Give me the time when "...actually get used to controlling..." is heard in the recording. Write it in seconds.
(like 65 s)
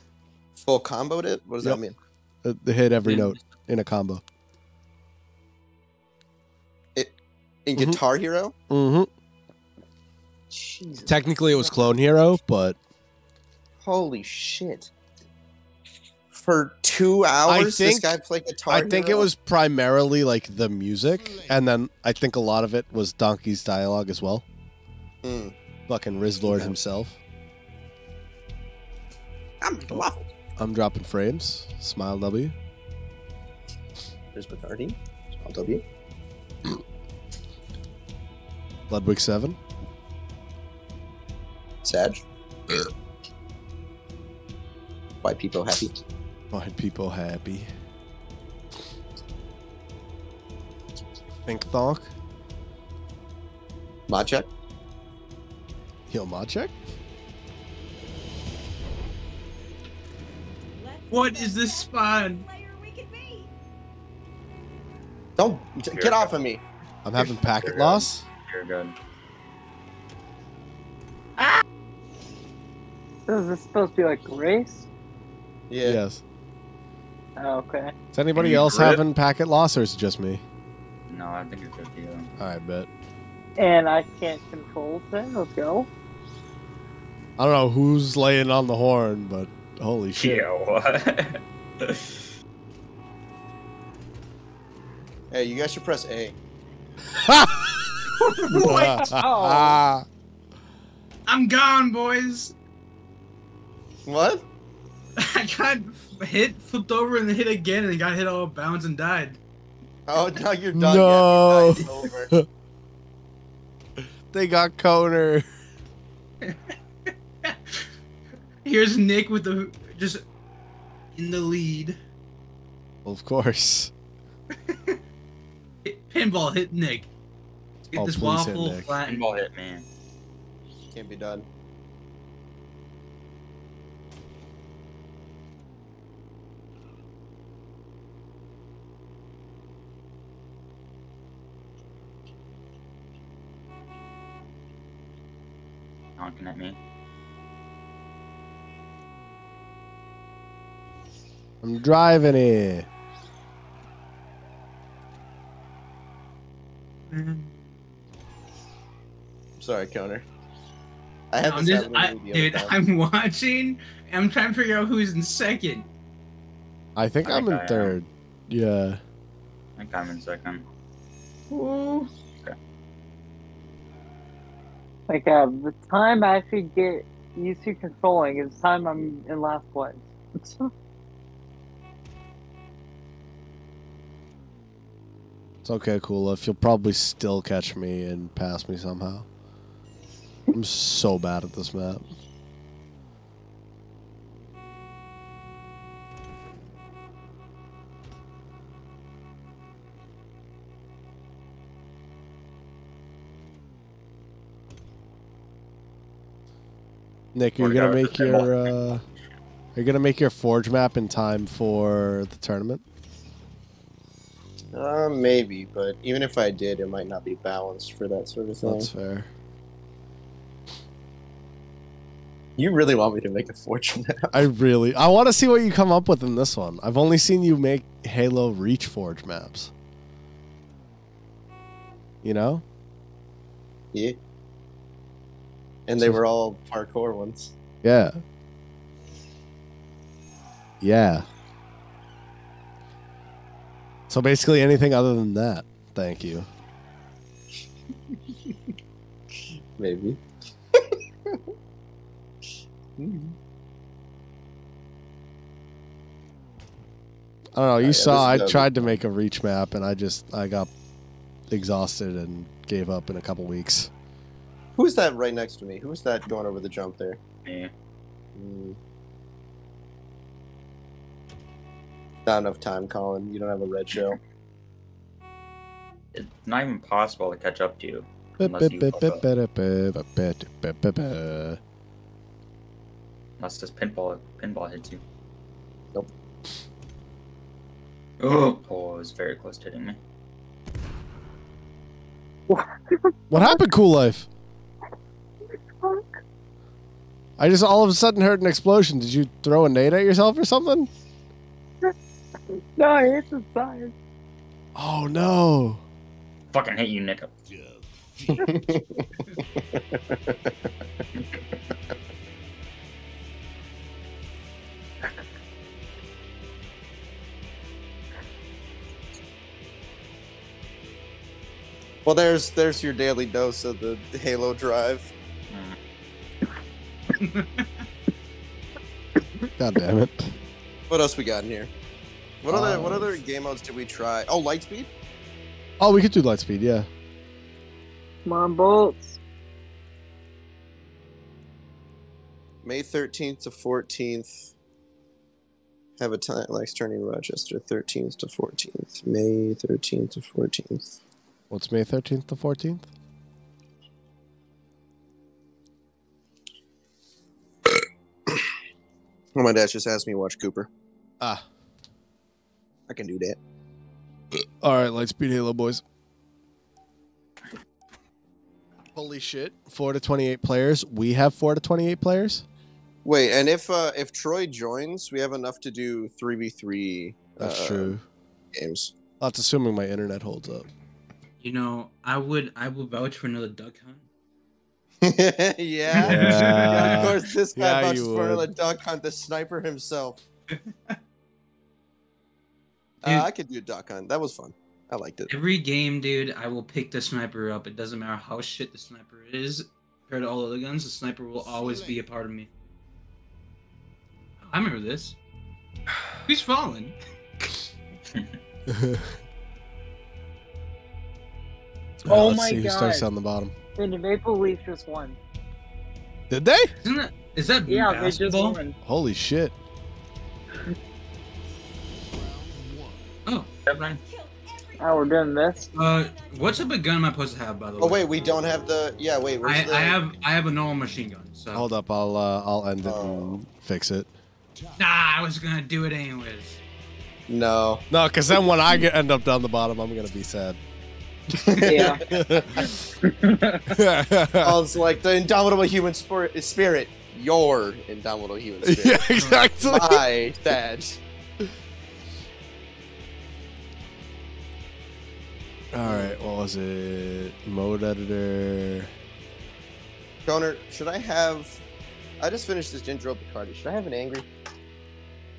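176 s.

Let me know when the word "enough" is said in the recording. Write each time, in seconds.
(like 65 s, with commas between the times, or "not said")
272 s, 375 s.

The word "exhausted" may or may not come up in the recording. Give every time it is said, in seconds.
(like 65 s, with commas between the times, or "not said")
261 s.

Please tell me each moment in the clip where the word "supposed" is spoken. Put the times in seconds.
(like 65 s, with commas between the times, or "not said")
73 s, 427 s.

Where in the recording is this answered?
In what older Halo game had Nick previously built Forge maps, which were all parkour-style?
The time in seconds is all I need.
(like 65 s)
228 s.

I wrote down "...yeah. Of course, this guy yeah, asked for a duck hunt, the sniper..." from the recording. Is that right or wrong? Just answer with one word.
wrong.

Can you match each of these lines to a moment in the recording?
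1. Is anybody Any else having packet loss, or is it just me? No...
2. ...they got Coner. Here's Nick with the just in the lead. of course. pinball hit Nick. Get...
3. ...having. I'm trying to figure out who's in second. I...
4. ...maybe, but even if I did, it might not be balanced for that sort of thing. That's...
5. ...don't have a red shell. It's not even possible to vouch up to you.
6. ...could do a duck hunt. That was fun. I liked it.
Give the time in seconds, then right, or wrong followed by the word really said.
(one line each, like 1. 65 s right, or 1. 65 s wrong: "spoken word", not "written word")
1. 78 s right
2. 114 s right
3. 162 s wrong: "watching", not "having"
4. 215 s right
5. 273 s wrong: "catch", not "vouch"
6. 393 s right.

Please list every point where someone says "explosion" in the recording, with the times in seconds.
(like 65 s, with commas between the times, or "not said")
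298 s.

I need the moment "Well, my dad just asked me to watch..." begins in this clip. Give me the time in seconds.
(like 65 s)
359 s.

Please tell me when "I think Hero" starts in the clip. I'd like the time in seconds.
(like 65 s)
18 s.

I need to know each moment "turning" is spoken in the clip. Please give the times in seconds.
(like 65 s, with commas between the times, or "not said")
346 s.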